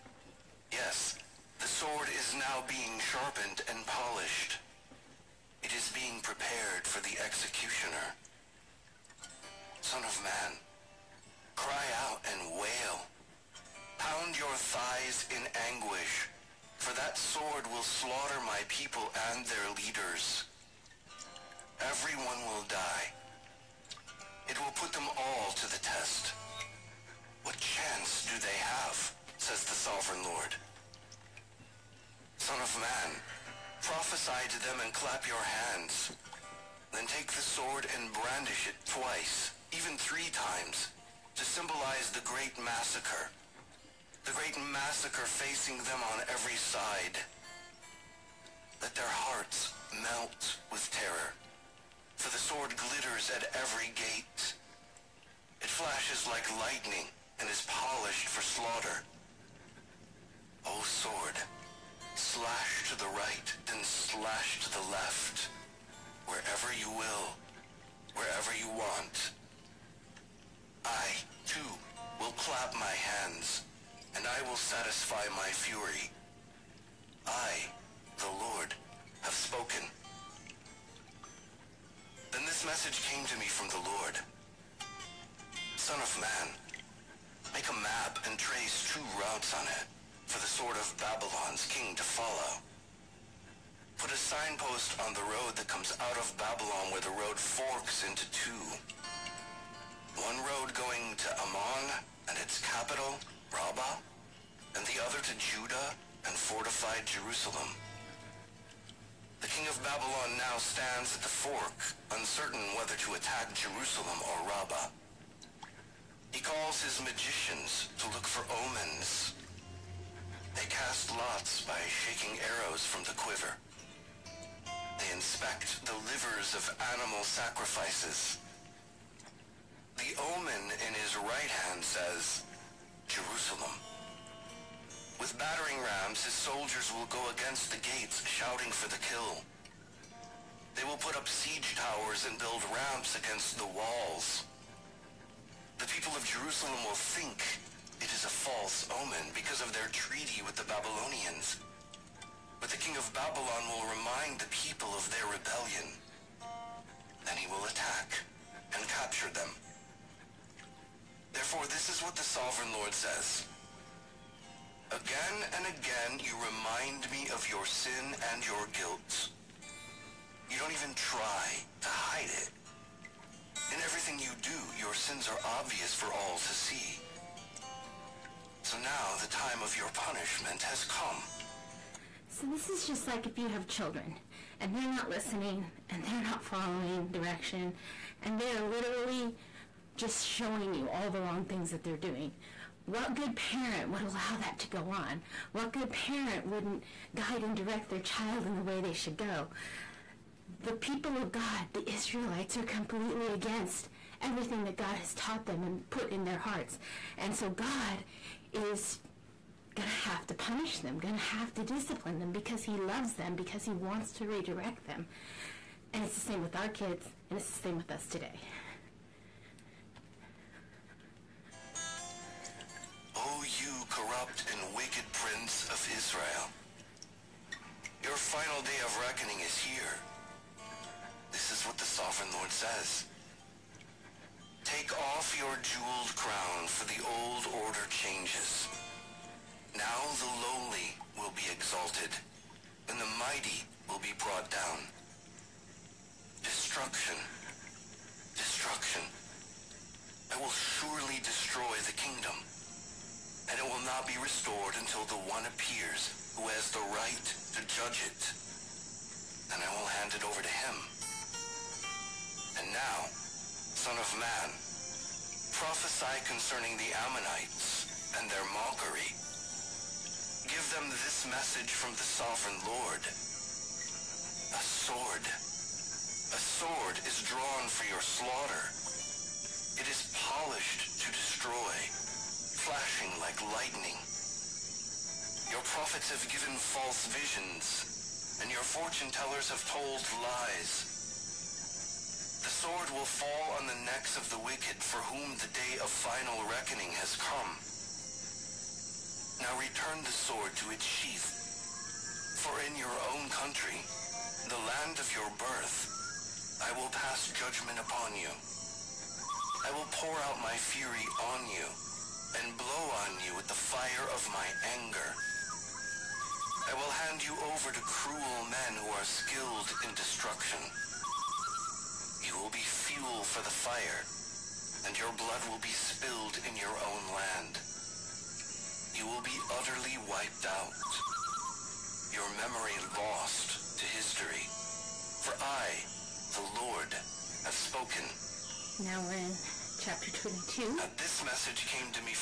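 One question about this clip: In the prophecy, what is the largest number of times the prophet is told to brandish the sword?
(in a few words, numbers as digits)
3.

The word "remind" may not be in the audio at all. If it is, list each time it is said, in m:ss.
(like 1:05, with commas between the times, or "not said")
2:33, 2:46.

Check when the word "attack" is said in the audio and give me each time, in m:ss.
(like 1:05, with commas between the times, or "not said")
1:53, 2:37.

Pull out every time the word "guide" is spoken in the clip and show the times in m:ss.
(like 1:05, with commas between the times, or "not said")
3:17.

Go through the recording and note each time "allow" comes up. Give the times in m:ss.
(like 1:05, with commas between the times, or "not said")
3:14.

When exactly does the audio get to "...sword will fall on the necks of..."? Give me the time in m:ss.
4:52.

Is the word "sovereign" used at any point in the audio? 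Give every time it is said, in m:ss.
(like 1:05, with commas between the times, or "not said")
0:29, 2:42, 3:51, 4:32.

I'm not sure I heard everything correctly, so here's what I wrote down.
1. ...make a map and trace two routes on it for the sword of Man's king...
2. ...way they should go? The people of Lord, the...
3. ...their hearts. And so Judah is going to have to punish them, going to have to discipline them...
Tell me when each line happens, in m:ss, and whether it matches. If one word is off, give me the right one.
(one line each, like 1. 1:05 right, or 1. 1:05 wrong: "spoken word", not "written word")
1. 1:27 wrong: "Babylon", not "Man"
2. 3:18 wrong: "God", not "Lord"
3. 3:26 wrong: "God", not "Judah".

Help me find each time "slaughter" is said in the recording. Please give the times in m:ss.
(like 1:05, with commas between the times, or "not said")
0:17, 0:58, 4:38.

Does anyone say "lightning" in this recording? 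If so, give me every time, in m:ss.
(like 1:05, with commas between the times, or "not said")
0:56, 4:43.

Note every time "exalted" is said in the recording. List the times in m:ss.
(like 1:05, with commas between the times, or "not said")
4:01.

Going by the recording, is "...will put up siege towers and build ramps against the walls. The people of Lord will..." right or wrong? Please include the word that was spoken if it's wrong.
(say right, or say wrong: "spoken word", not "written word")
wrong: "Jerusalem", not "Lord".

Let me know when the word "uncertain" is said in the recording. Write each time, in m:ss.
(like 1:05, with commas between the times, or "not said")
1:52.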